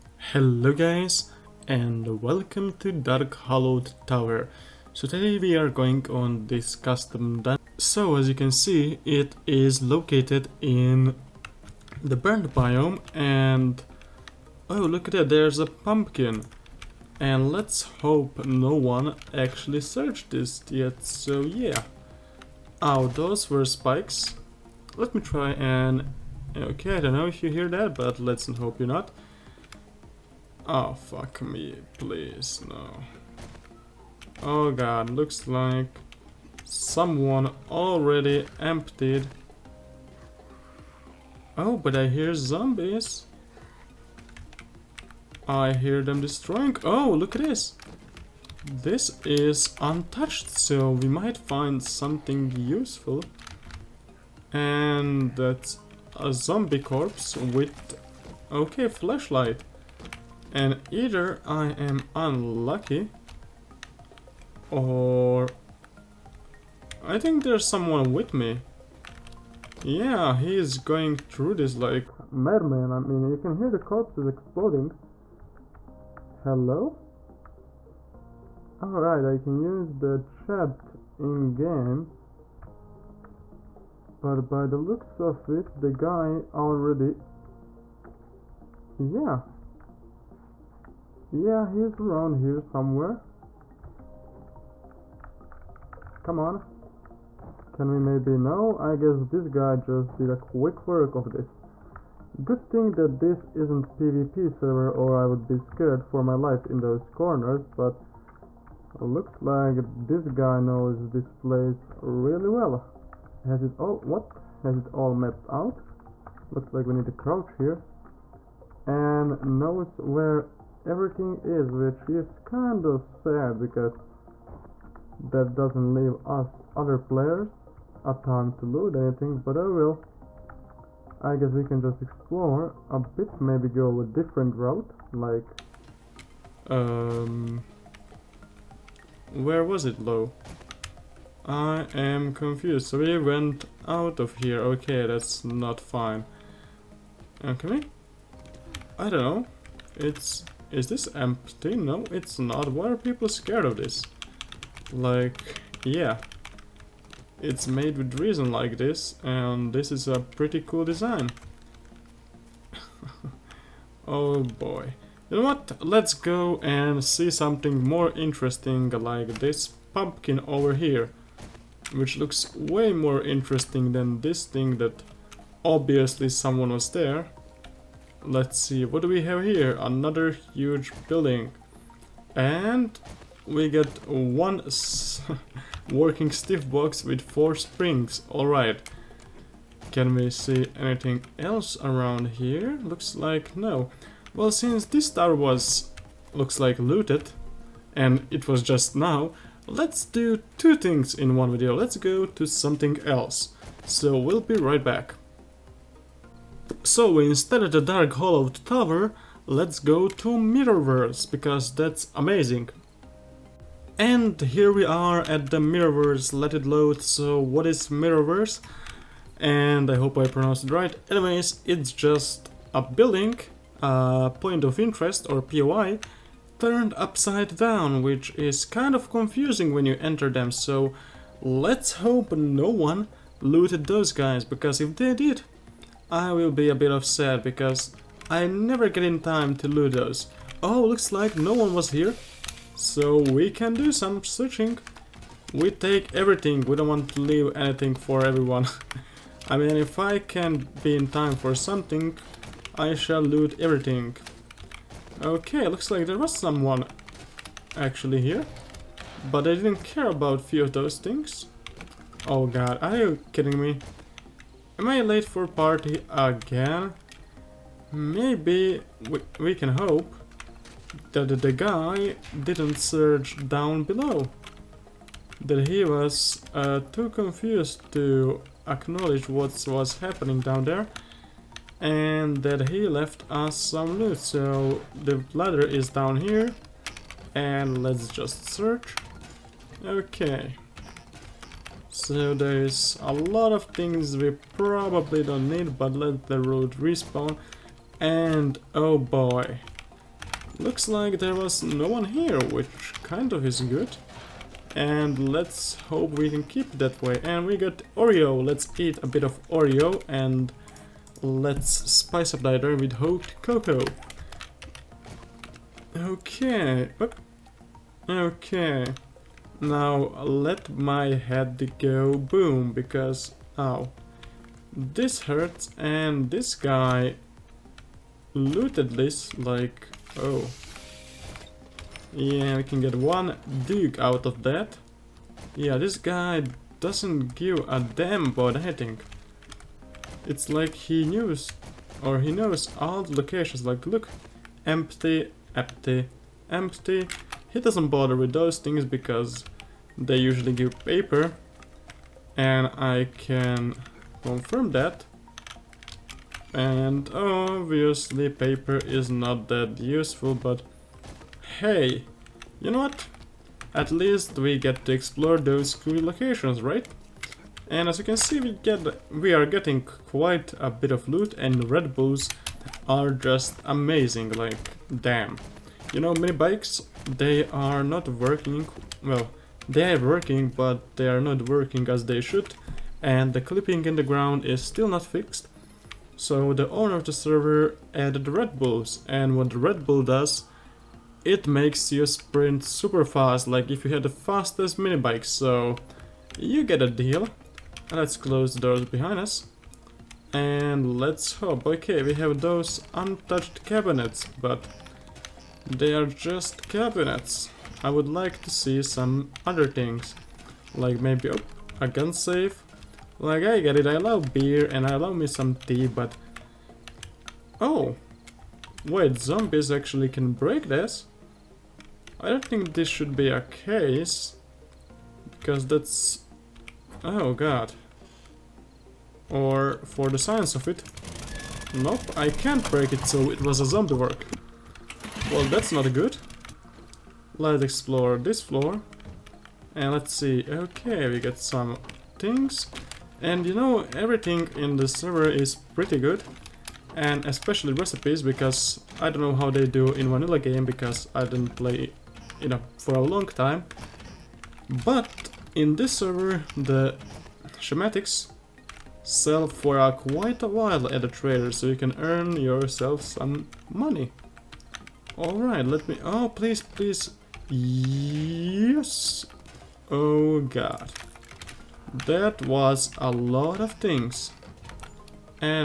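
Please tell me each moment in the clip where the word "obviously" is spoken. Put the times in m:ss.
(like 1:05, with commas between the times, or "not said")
2:55, 5:57.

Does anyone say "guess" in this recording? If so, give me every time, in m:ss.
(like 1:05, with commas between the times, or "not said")
1:38, 2:11.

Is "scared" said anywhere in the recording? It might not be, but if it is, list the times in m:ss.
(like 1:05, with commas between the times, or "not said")
1:45, 2:33.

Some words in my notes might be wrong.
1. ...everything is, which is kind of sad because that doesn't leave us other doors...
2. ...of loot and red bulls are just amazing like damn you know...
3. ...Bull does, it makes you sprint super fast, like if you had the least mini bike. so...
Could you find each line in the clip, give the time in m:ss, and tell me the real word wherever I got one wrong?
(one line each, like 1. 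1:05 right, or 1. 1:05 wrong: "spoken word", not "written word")
1. 2:00 wrong: "players", not "doors"
2. 6:10 right
3. 6:29 wrong: "fastest", not "least".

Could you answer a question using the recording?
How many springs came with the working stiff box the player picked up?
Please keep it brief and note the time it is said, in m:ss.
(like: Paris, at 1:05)
4, at 3:07.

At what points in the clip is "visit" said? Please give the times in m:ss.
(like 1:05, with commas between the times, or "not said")
not said.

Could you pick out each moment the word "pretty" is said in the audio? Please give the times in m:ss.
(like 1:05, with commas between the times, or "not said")
2:40, 7:25.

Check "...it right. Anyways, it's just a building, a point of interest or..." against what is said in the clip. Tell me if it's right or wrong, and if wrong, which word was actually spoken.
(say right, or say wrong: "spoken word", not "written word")
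right.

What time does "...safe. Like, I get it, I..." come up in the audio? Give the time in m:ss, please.
6:52.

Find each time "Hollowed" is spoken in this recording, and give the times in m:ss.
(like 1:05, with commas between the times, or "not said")
0:03, 3:28.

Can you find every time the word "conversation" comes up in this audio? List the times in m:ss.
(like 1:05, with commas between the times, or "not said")
not said.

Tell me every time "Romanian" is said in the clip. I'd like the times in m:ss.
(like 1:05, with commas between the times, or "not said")
not said.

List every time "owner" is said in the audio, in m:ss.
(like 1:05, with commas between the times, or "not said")
6:26.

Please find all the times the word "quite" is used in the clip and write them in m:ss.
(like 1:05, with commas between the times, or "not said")
6:09, 7:39.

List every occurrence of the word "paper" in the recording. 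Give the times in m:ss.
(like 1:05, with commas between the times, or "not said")
5:50, 5:58.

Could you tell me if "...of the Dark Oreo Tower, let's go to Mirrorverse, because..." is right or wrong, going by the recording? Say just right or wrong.
wrong.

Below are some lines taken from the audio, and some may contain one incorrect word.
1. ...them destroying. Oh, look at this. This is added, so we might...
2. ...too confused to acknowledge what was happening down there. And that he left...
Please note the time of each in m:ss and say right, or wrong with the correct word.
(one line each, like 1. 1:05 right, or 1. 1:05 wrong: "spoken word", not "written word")
1. 0:46 wrong: "untouched", not "added"
2. 4:36 right.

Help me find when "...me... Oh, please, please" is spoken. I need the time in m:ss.
7:45.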